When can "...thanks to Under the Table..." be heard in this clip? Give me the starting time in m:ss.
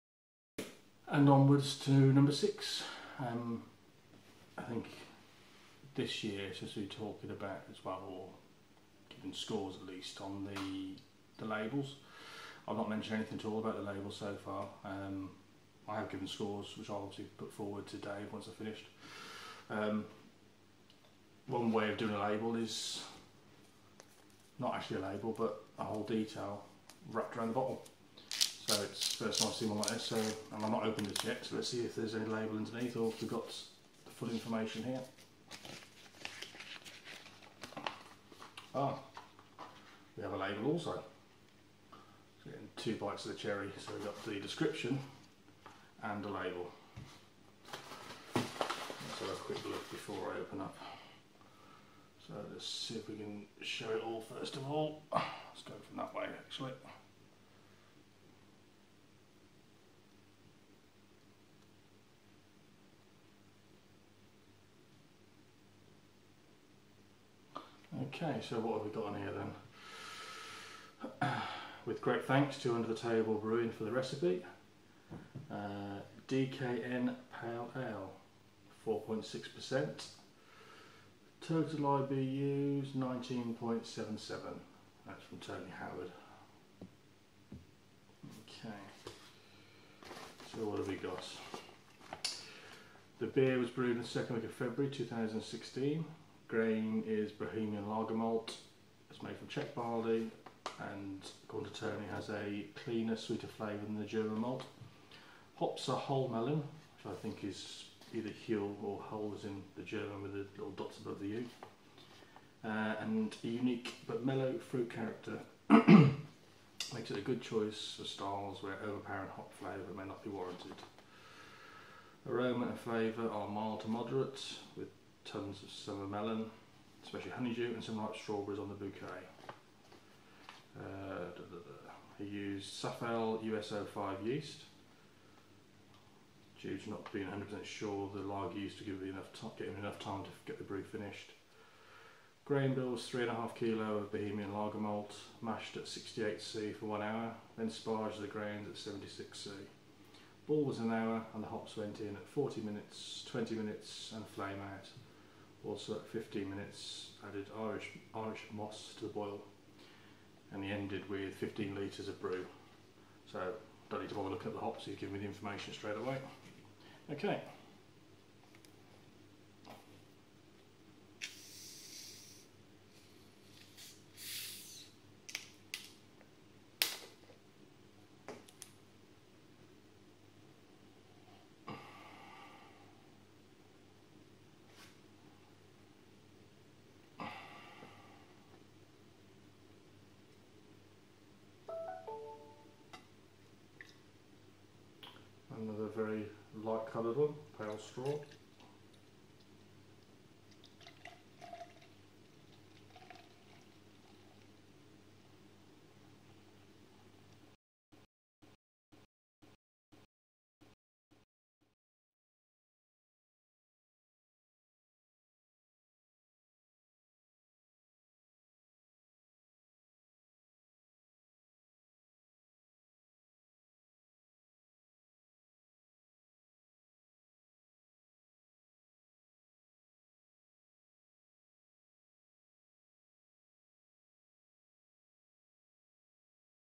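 1:12.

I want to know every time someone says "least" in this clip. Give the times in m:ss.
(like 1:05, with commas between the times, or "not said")
0:09.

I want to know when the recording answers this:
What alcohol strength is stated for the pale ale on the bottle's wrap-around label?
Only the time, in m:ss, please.
1:18.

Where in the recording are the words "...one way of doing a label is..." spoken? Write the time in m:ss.
0:21.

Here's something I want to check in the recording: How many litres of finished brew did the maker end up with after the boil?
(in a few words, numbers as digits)
15 litres.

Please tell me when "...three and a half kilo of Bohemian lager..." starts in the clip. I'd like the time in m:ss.
2:23.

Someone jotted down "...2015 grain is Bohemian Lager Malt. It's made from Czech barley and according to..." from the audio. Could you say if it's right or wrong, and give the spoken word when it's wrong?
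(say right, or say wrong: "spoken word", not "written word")
wrong: "2016", not "2015".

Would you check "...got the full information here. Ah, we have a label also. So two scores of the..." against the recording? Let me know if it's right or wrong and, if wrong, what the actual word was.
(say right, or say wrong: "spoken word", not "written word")
wrong: "bites", not "scores".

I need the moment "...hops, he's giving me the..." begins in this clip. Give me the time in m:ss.
2:44.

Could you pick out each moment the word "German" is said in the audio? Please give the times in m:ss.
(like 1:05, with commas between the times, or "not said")
1:44, 1:49.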